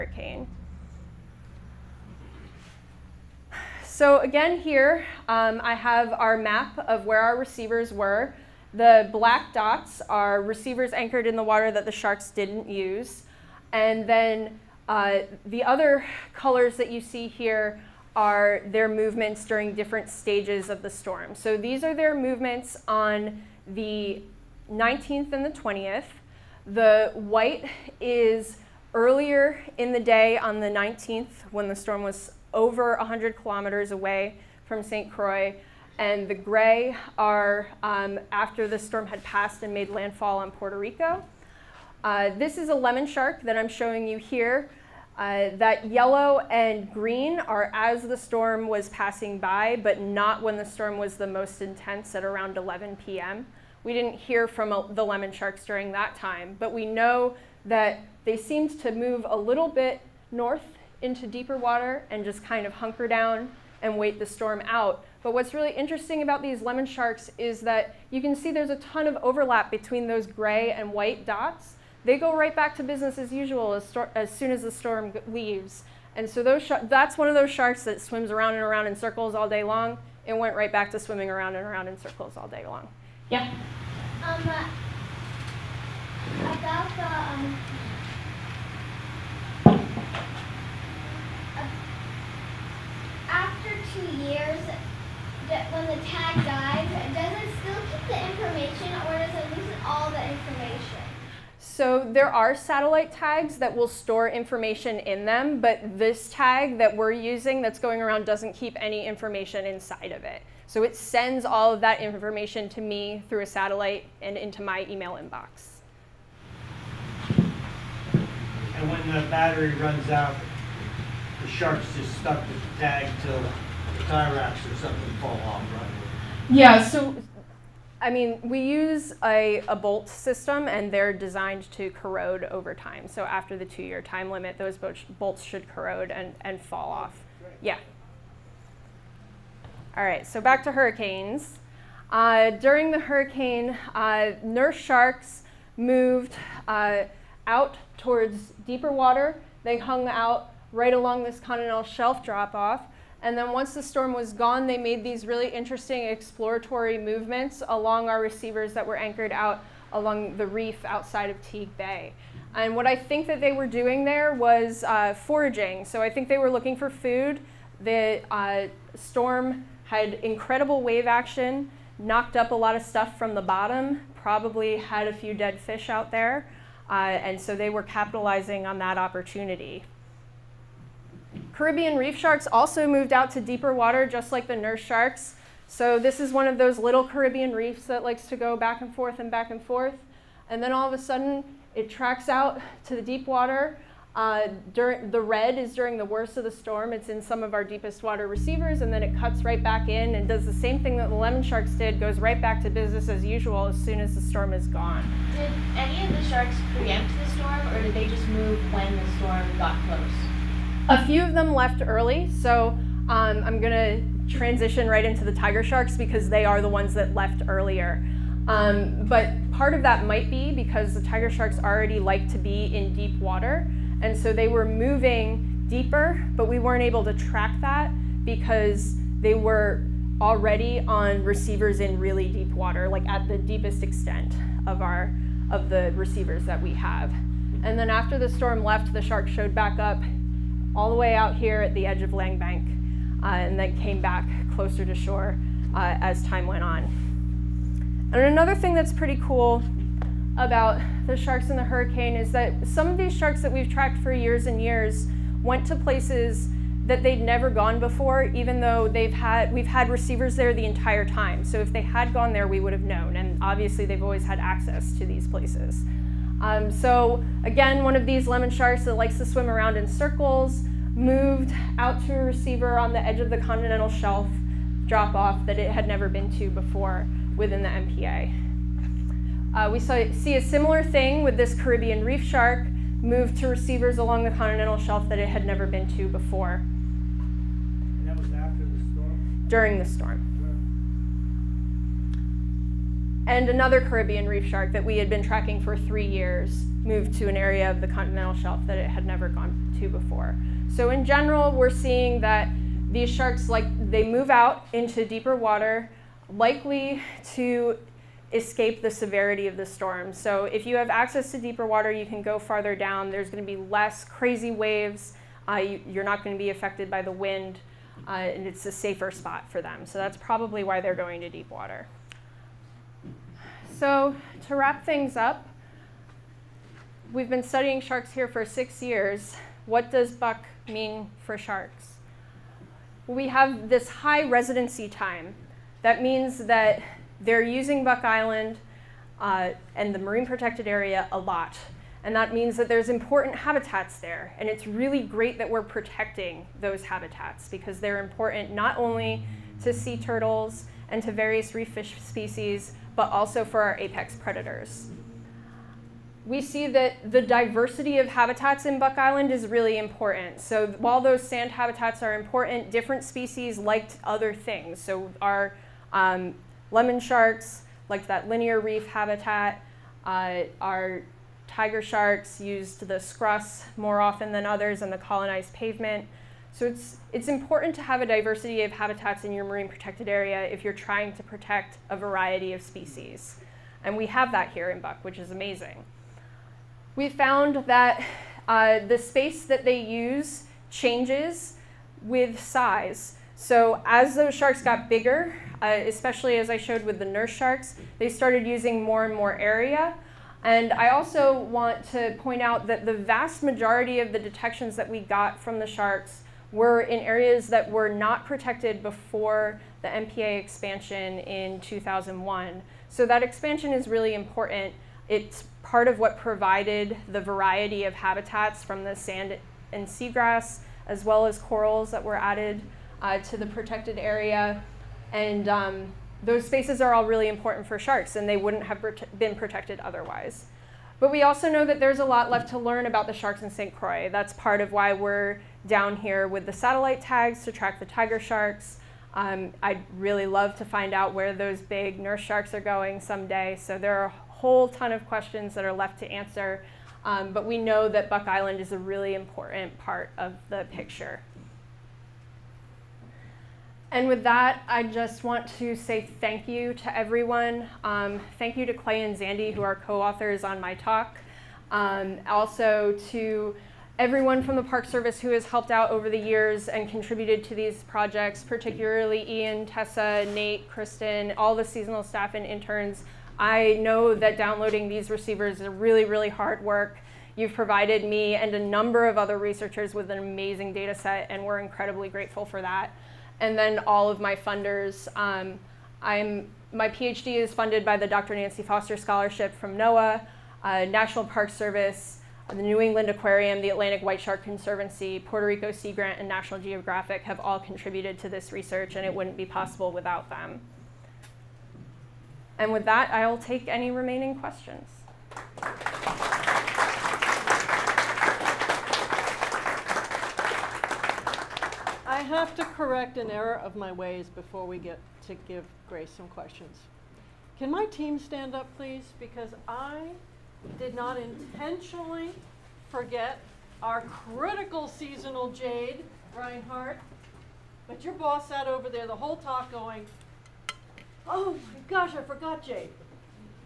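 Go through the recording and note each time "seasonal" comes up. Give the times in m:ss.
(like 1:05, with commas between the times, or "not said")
7:51, 8:44.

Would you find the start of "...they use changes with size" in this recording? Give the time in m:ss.
6:29.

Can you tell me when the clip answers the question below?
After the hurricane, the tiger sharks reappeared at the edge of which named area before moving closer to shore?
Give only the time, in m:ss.
4:02.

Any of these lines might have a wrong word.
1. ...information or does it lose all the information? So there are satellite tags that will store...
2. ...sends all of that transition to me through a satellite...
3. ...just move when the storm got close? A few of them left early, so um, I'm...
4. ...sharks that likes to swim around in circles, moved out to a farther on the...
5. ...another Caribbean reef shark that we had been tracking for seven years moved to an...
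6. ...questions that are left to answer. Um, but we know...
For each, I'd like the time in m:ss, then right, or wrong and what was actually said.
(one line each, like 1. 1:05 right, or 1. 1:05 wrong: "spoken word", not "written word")
1. 1:38 right
2. 1:50 wrong: "information", not "transition"
3. 3:28 right
4. 4:28 wrong: "receiver", not "farther"
5. 4:53 wrong: "three", not "seven"
6. 7:25 right.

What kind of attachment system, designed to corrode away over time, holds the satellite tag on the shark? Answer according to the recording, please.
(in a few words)
bolt system.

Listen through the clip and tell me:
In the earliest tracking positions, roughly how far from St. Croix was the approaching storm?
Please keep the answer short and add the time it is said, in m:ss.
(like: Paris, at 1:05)
over 100 kilometers, at 0:32.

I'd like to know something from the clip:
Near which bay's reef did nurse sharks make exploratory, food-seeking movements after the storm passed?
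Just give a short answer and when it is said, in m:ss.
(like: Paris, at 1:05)
Teague Bay, at 2:41.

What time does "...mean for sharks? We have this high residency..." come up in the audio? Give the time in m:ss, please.
5:30.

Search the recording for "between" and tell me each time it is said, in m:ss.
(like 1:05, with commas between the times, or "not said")
1:09.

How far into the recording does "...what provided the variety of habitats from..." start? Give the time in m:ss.
6:55.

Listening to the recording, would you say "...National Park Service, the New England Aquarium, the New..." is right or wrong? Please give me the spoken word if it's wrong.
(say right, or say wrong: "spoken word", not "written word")
wrong: "Atlantic", not "New".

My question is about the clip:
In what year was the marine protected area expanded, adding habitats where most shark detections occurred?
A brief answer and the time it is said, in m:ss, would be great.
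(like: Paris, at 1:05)
2001, at 6:51.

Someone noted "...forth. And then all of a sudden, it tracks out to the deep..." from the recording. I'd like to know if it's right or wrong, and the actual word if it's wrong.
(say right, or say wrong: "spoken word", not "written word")
right.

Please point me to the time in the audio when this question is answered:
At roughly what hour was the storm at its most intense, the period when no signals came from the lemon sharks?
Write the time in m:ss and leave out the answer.
0:52.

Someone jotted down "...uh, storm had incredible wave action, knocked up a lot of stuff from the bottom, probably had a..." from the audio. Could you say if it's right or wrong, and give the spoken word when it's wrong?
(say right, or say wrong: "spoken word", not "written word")
right.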